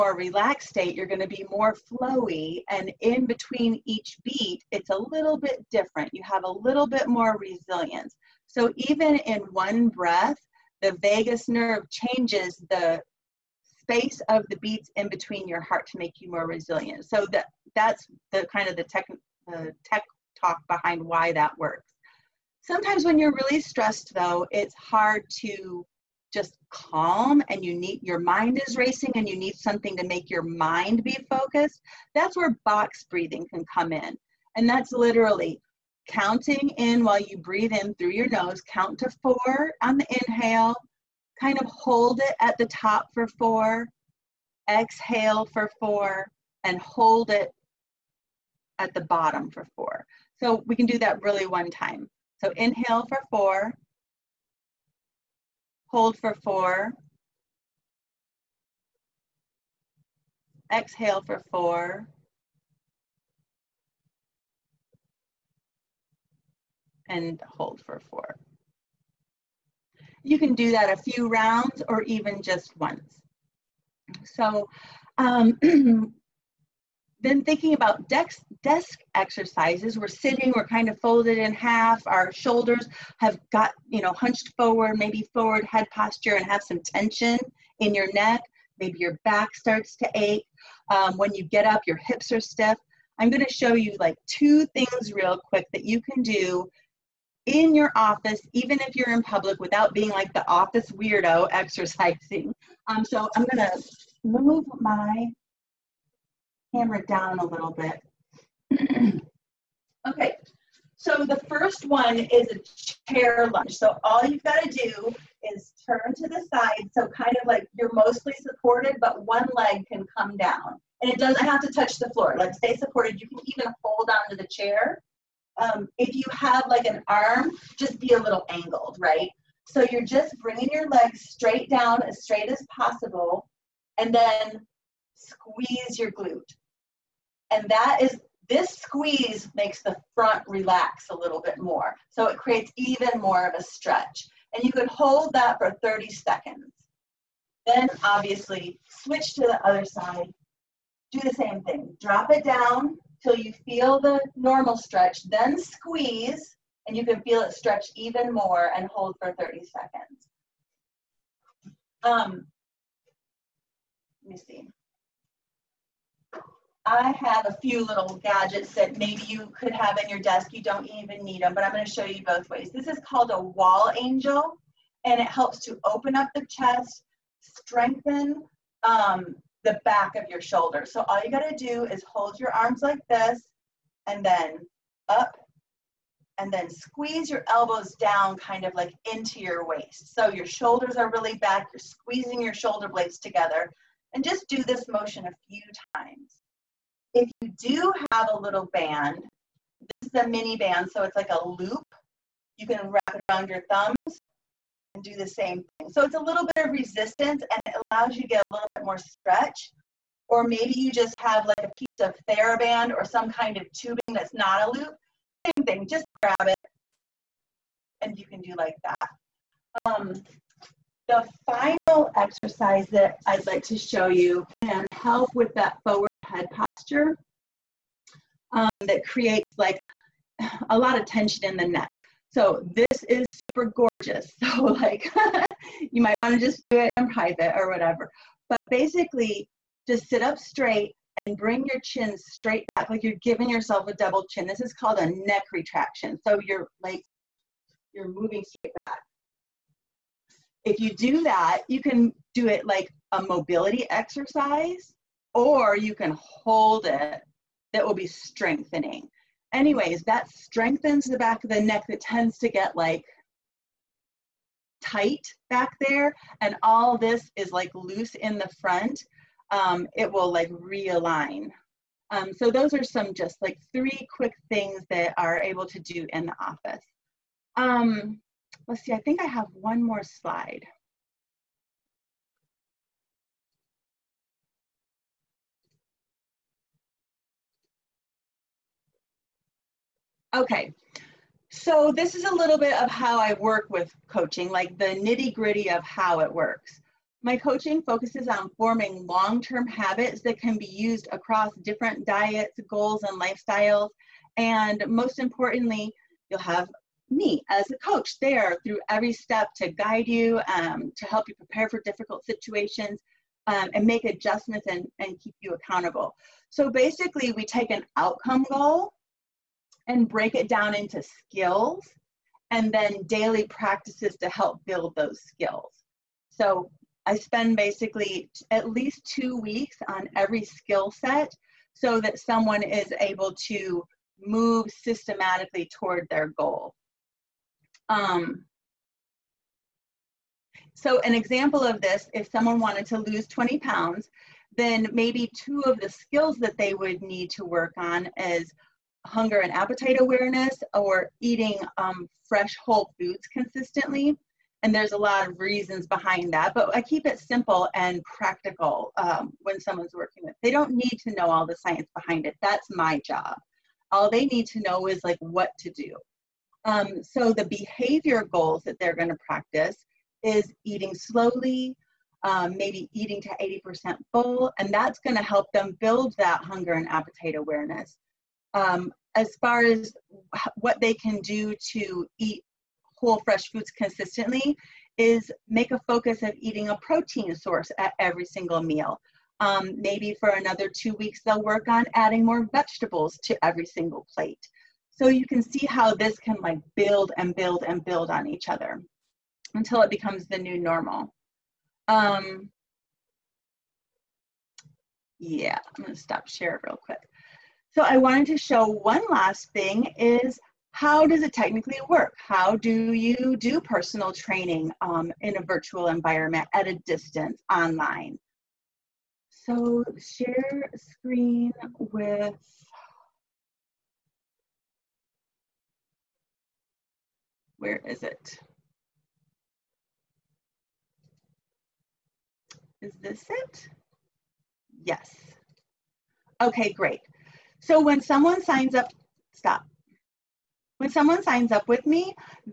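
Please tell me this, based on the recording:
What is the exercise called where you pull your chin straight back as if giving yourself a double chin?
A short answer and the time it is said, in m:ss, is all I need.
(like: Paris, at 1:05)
neck retraction, at 4:05.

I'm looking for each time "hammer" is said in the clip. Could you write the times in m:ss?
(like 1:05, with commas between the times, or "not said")
1:46.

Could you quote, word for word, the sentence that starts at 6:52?
How do you do personal training um, in a virtual environment at a distance online?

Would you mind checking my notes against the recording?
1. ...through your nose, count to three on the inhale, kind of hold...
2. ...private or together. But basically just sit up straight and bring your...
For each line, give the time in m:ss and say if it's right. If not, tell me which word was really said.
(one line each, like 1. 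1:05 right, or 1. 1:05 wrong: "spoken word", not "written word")
1. 0:37 wrong: "four", not "three"
2. 3:57 wrong: "whatever", not "together".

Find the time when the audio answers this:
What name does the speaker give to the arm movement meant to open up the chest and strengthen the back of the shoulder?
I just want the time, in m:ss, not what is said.
2:53.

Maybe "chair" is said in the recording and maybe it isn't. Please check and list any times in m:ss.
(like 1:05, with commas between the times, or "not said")
1:53, 2:04.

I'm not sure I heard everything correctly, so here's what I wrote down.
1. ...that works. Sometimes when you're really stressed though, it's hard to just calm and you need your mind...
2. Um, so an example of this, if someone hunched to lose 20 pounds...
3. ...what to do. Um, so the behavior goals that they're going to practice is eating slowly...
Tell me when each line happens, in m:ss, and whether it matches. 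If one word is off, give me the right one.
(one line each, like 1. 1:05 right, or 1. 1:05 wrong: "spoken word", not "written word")
1. 0:21 right
2. 5:37 wrong: "wanted", not "hunched"
3. 6:05 right.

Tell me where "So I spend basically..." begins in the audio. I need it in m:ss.
5:26.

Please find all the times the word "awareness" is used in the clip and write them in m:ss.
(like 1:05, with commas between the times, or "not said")
5:49, 6:17.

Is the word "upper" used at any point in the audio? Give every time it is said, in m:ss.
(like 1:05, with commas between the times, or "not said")
not said.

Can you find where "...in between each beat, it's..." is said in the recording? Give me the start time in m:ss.
0:02.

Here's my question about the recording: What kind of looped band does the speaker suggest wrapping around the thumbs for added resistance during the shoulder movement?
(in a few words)
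mini band.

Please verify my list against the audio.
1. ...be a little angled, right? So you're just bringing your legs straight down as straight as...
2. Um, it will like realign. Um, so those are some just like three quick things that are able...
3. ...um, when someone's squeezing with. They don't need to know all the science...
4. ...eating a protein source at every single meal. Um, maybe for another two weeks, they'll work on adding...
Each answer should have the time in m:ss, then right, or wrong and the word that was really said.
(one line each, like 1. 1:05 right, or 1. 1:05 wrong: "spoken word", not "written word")
1. 2:07 right
2. 4:29 right
3. 5:58 wrong: "working", not "squeezing"
4. 6:26 right.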